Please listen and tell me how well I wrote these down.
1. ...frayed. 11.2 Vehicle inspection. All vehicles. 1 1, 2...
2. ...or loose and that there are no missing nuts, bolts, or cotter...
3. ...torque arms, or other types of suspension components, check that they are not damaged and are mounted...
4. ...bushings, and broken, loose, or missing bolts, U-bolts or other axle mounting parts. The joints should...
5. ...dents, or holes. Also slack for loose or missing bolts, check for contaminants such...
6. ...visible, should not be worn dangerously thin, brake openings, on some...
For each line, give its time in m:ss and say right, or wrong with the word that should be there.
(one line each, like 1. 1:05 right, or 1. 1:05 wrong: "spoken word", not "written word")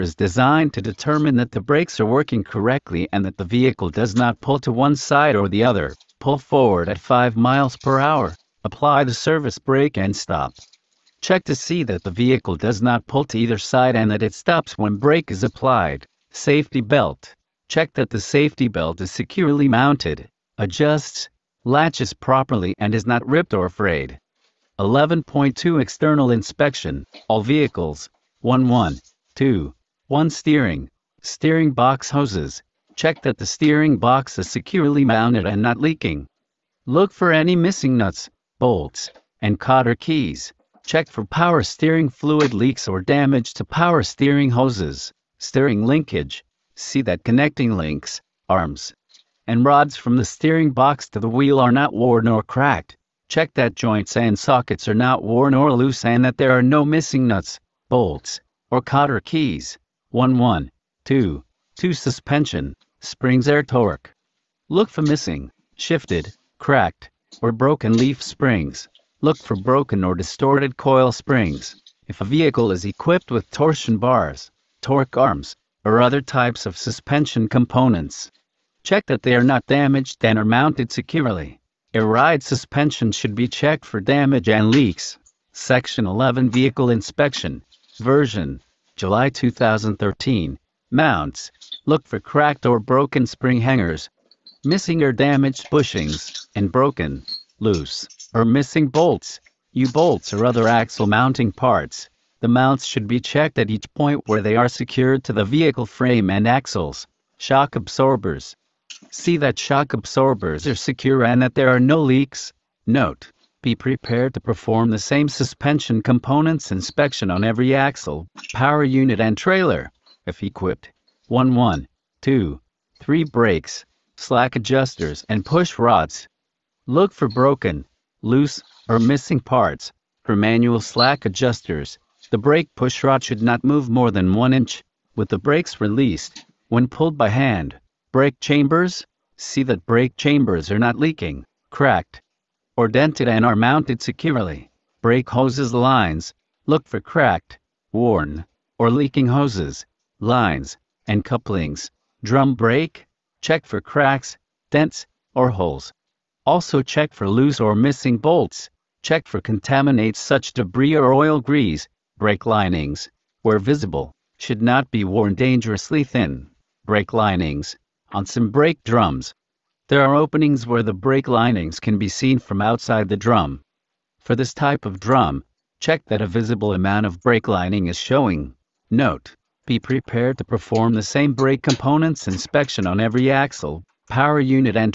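1. 0:23 wrong: "External", not "Vehicle"
2. 0:55 right
3. 1:14 right
4. 1:35 wrong: "mounts", not "joints"
5. 2:34 wrong: "check", not "slack"
6. 2:43 wrong: "linings", not "openings".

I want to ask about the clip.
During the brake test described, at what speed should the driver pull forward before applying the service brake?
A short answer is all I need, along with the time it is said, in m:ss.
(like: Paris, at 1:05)
5 miles per hour, at 0:06.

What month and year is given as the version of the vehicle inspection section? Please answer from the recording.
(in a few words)
July 2013.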